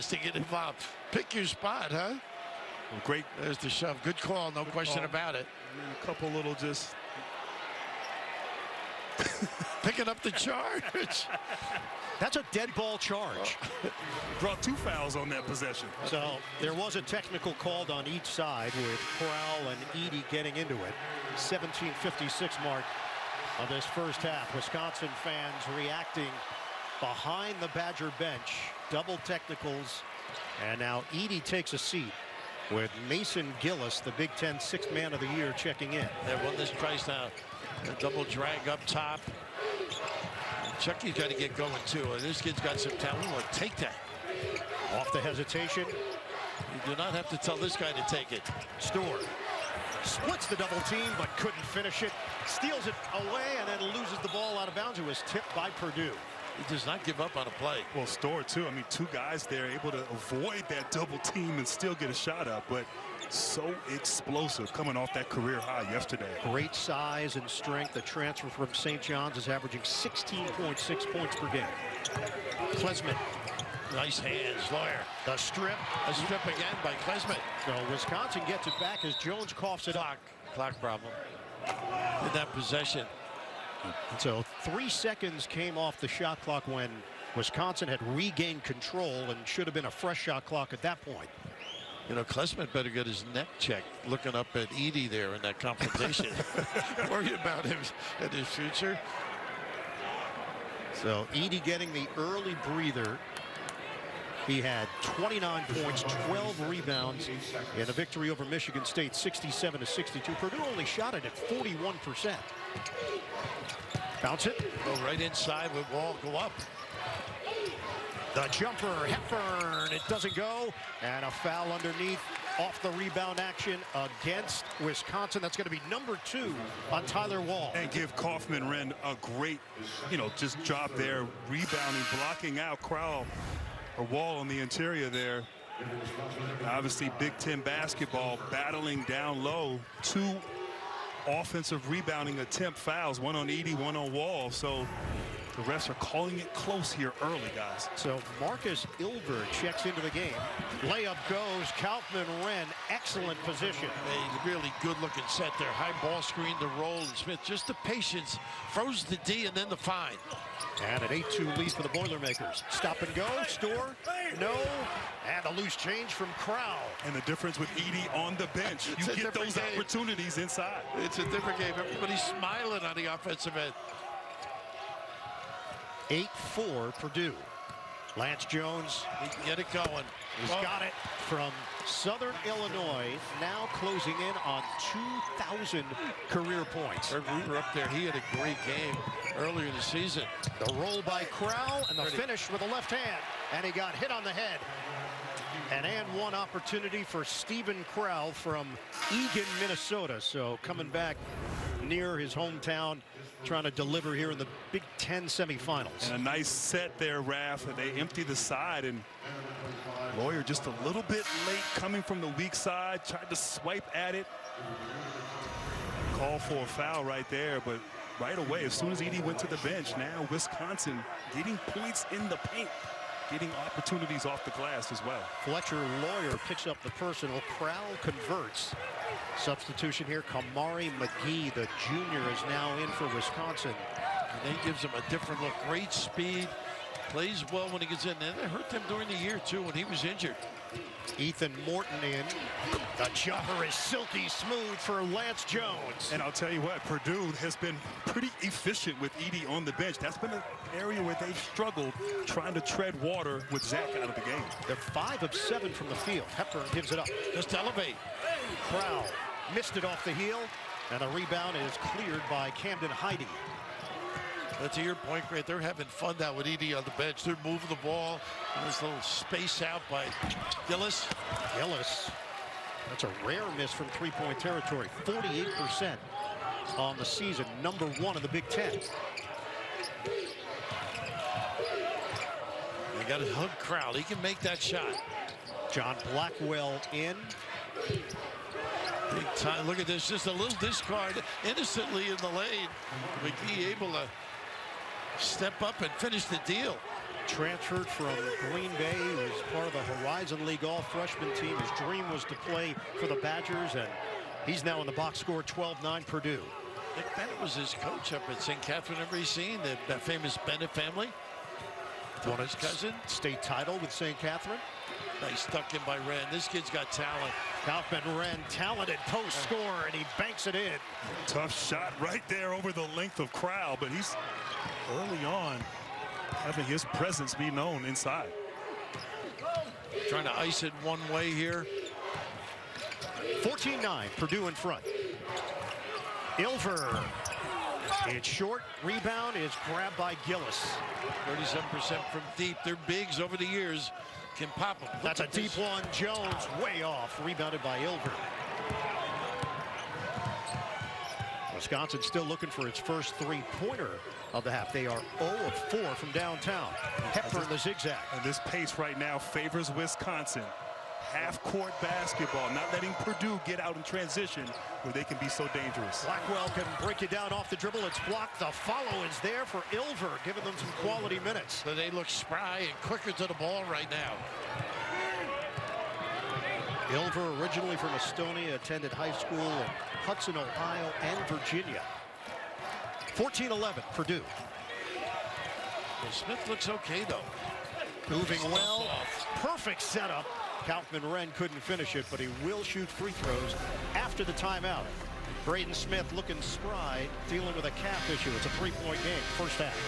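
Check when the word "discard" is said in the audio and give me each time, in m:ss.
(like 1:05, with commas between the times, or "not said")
4:50.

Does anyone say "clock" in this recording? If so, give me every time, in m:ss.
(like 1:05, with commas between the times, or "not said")
1:20, 1:26, 1:30.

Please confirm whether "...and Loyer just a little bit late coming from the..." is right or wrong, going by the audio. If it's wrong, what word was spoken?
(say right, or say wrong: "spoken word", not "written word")
right.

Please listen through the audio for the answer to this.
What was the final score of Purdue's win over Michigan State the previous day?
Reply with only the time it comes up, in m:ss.
1:49.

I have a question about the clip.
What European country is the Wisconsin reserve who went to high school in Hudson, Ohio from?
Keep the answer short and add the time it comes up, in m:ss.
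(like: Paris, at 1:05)
Estonia, at 6:17.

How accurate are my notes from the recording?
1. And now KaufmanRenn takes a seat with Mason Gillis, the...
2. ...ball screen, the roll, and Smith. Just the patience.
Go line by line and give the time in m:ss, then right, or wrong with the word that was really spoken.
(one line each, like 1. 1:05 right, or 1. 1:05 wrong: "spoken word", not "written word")
1. 0:30 wrong: "Edey", not "KaufmanRenn"
2. 2:36 right.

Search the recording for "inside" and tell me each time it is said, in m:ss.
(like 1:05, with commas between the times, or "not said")
1:55, 2:50, 5:27.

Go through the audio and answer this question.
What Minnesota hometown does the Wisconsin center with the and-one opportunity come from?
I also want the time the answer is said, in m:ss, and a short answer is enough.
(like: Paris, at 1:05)
Eagan, Minnesota, at 3:19.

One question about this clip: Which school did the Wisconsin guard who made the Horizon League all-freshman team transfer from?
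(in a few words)
Green Bay.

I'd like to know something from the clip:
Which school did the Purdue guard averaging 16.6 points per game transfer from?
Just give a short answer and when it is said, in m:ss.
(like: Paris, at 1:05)
St. John's, at 1:08.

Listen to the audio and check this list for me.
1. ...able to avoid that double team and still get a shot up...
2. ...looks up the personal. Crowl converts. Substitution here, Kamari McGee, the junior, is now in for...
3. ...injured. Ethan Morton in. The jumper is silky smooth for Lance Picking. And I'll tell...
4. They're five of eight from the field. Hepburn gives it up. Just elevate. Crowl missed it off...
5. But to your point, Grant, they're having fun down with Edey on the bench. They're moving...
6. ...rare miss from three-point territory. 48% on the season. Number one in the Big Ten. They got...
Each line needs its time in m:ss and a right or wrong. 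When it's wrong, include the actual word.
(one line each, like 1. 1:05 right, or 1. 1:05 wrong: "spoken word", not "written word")
1. 0:59 right
2. 3:46 wrong: "picks", not "looks"
3. 4:00 wrong: "Jones", not "Picking"
4. 4:14 wrong: "seven", not "eight"
5. 4:24 right
6. 4:33 right.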